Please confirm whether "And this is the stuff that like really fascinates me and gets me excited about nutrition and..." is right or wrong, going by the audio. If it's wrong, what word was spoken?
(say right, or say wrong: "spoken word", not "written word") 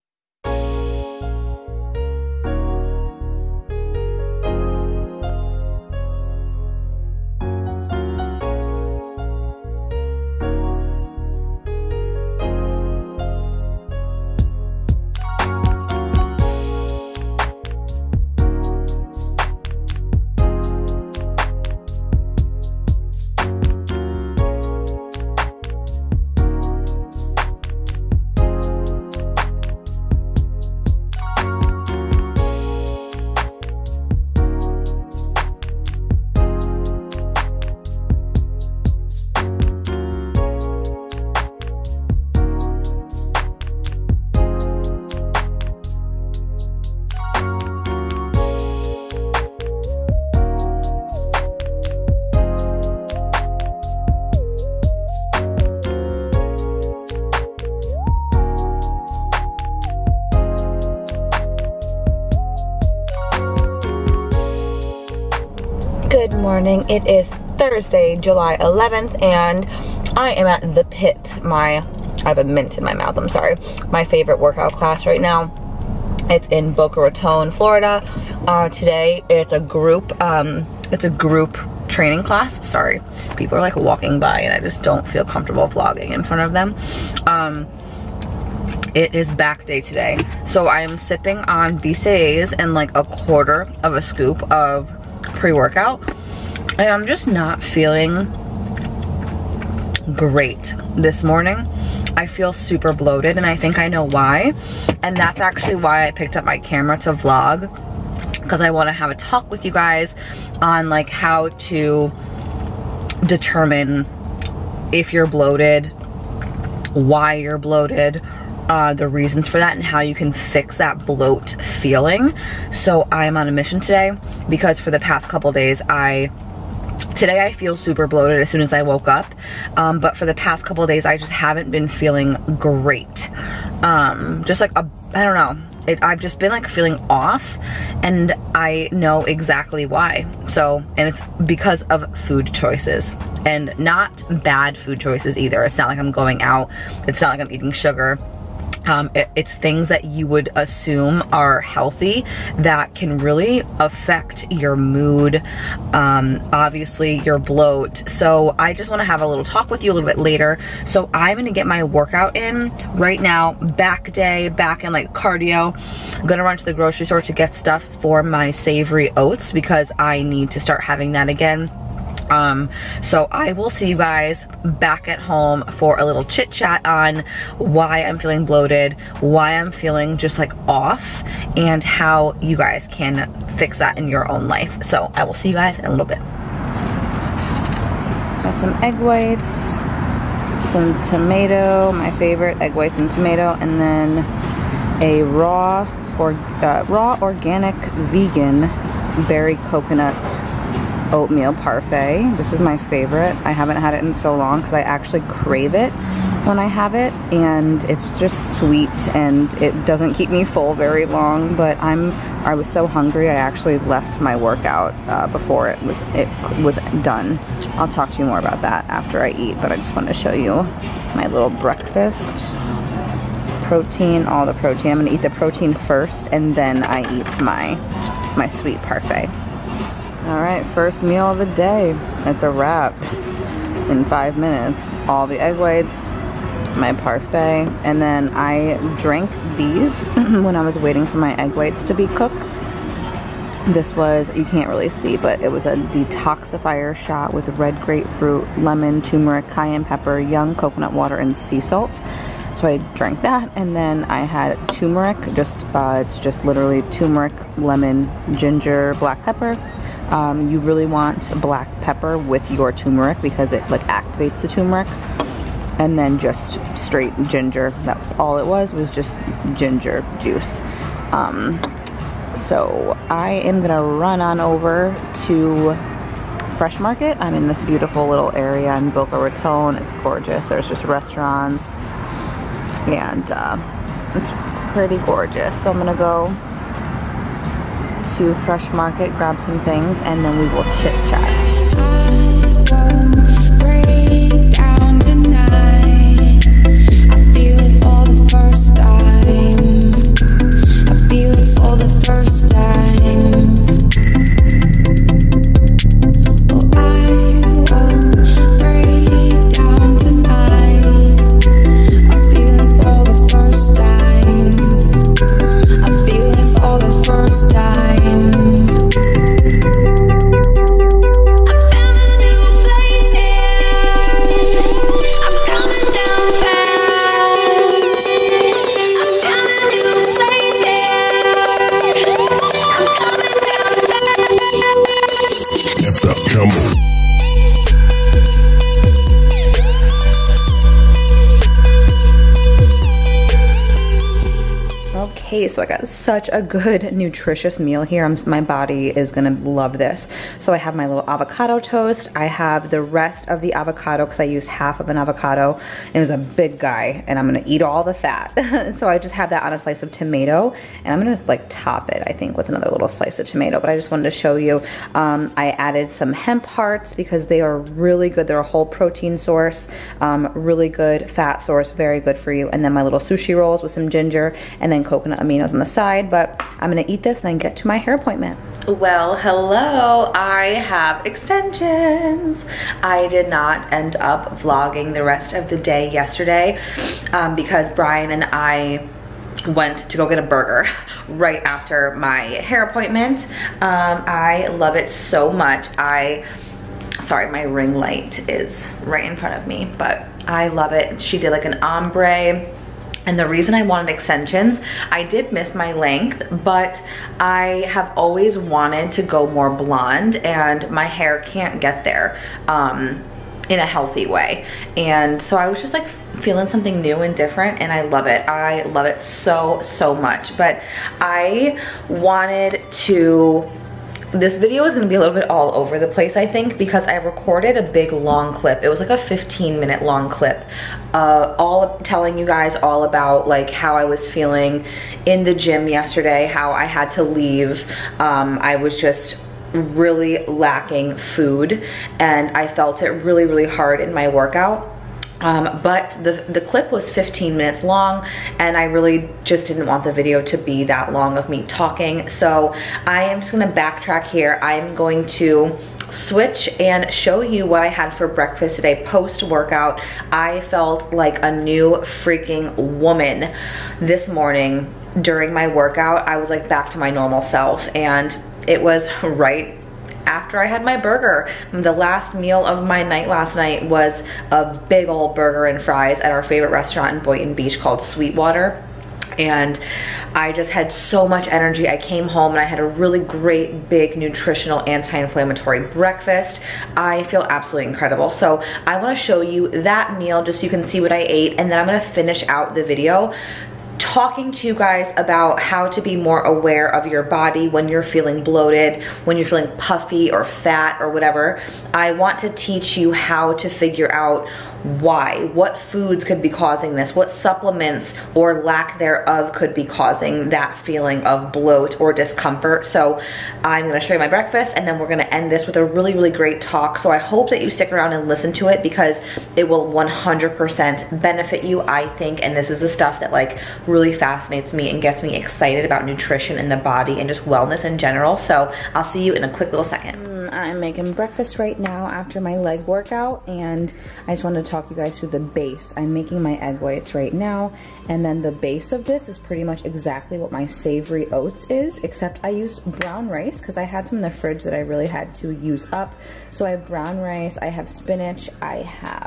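right.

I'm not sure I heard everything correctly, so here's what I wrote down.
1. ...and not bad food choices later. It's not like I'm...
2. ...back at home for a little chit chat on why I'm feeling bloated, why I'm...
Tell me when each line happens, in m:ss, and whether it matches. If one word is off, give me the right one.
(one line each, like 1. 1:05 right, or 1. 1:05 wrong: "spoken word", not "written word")
1. 2:23 wrong: "either", not "later"
2. 2:54 right.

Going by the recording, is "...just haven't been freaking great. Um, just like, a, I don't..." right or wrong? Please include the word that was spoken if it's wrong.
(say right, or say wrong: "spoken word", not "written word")
wrong: "feeling", not "freaking".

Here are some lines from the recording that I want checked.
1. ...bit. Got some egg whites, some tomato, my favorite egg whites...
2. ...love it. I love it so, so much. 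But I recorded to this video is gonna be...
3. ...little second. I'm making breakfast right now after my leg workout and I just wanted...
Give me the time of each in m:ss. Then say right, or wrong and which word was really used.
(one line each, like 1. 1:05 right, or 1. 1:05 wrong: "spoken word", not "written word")
1. 3:06 right
2. 6:57 wrong: "wanted", not "recorded"
3. 8:49 right.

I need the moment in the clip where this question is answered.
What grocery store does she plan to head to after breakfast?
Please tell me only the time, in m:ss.
4:36.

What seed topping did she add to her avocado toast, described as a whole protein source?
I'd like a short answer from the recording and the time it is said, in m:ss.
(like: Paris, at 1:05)
Hemp hearts, at 6:06.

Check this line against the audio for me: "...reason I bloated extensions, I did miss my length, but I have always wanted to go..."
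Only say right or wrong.
wrong.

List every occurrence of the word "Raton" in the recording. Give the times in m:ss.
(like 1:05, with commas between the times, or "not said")
1:17, 4:39.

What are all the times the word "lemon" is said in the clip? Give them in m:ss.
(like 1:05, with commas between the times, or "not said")
4:08, 4:17.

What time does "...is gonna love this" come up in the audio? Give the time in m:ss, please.
5:48.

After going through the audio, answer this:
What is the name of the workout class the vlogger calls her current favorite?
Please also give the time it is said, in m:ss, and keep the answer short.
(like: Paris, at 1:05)
The Pit, at 1:10.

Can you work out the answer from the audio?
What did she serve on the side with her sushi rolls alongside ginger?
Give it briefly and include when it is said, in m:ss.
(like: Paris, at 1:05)
Coconut aminos, at 6:14.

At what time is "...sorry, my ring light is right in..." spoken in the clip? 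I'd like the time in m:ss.
6:37.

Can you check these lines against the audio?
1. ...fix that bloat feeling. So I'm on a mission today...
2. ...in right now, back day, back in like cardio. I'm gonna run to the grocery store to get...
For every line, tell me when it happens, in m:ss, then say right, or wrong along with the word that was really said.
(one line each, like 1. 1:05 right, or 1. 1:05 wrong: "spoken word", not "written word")
1. 2:00 right
2. 2:42 right.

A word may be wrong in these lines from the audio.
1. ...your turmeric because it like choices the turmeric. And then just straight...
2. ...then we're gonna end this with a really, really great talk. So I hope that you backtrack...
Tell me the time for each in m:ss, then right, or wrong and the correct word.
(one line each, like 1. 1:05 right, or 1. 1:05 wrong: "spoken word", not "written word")
1. 4:22 wrong: "activates", not "choices"
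2. 8:34 wrong: "stick", not "backtrack".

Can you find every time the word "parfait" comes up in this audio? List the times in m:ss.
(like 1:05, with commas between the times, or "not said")
3:21, 3:48, 3:56.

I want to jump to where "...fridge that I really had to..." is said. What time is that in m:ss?
9:04.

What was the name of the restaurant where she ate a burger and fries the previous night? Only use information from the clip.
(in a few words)
Sweetwater.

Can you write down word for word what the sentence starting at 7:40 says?
I felt like a new freaking woman this morning during my workout.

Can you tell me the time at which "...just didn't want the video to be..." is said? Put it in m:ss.
7:29.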